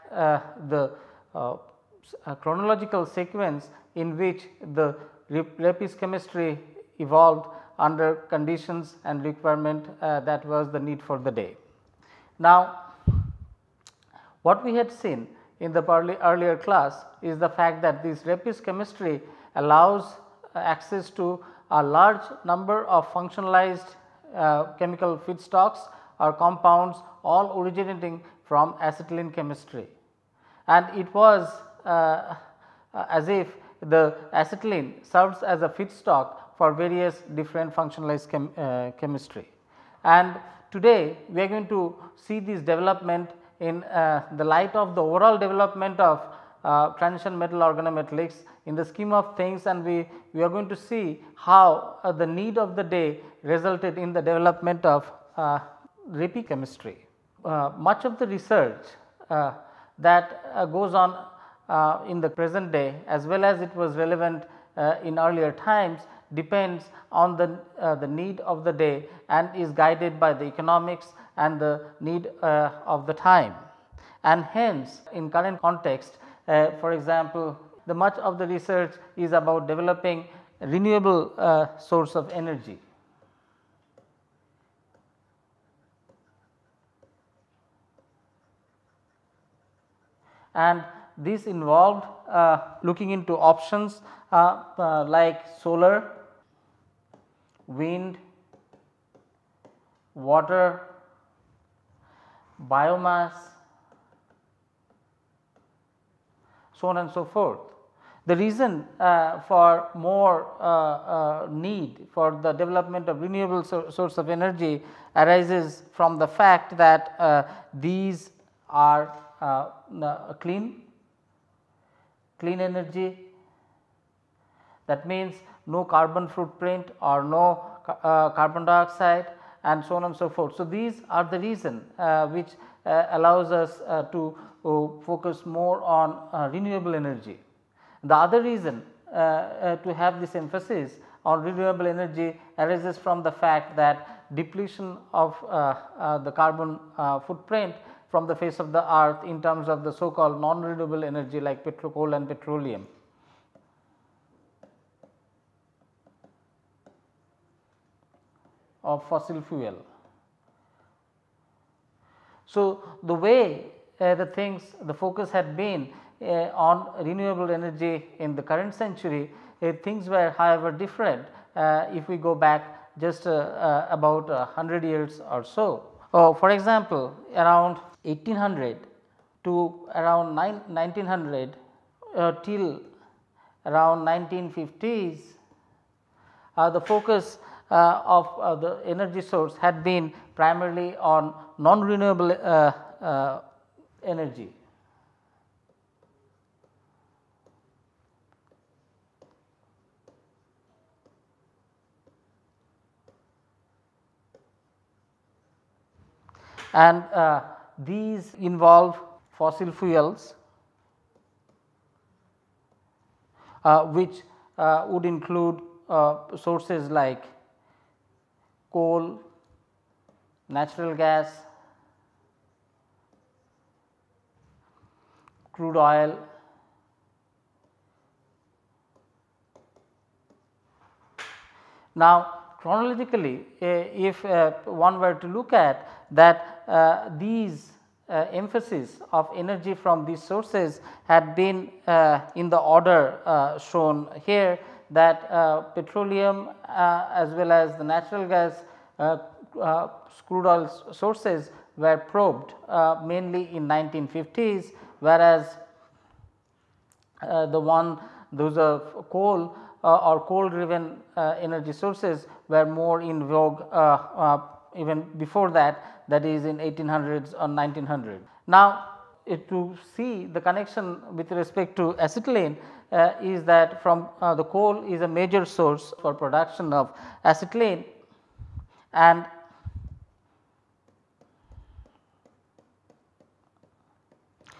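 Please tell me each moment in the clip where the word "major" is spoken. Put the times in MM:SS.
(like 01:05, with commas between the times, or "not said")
04:35.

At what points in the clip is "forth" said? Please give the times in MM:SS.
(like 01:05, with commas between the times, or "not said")
01:47, 02:10.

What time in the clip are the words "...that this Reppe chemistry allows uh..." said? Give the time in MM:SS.
00:17.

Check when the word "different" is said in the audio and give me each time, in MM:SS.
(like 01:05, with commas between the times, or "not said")
00:37, 02:50.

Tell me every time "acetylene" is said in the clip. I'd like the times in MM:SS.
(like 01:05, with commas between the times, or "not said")
00:28, 00:34, 04:31, 04:37.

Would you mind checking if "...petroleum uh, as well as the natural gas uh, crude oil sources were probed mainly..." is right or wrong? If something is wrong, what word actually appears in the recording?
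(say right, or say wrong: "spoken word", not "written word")
right.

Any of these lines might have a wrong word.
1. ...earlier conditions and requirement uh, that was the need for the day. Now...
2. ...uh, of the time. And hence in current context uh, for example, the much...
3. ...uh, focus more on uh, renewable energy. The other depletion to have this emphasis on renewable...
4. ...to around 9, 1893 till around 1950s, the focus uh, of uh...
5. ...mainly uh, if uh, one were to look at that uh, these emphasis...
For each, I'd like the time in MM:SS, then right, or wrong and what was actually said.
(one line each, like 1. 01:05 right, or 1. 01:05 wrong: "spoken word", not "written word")
1. 00:07 wrong: "under", not "earlier"
2. 01:12 right
3. 02:14 wrong: "reason", not "depletion"
4. 02:59 wrong: "1900", not "1893"
5. 03:52 wrong: "chronologically", not "mainly".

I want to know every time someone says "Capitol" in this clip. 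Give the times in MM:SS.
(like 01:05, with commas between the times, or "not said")
not said.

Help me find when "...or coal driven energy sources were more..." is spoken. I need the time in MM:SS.
04:19.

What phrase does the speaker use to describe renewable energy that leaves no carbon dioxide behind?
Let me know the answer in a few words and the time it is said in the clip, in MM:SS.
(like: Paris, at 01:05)
Clean energy, at 02:02.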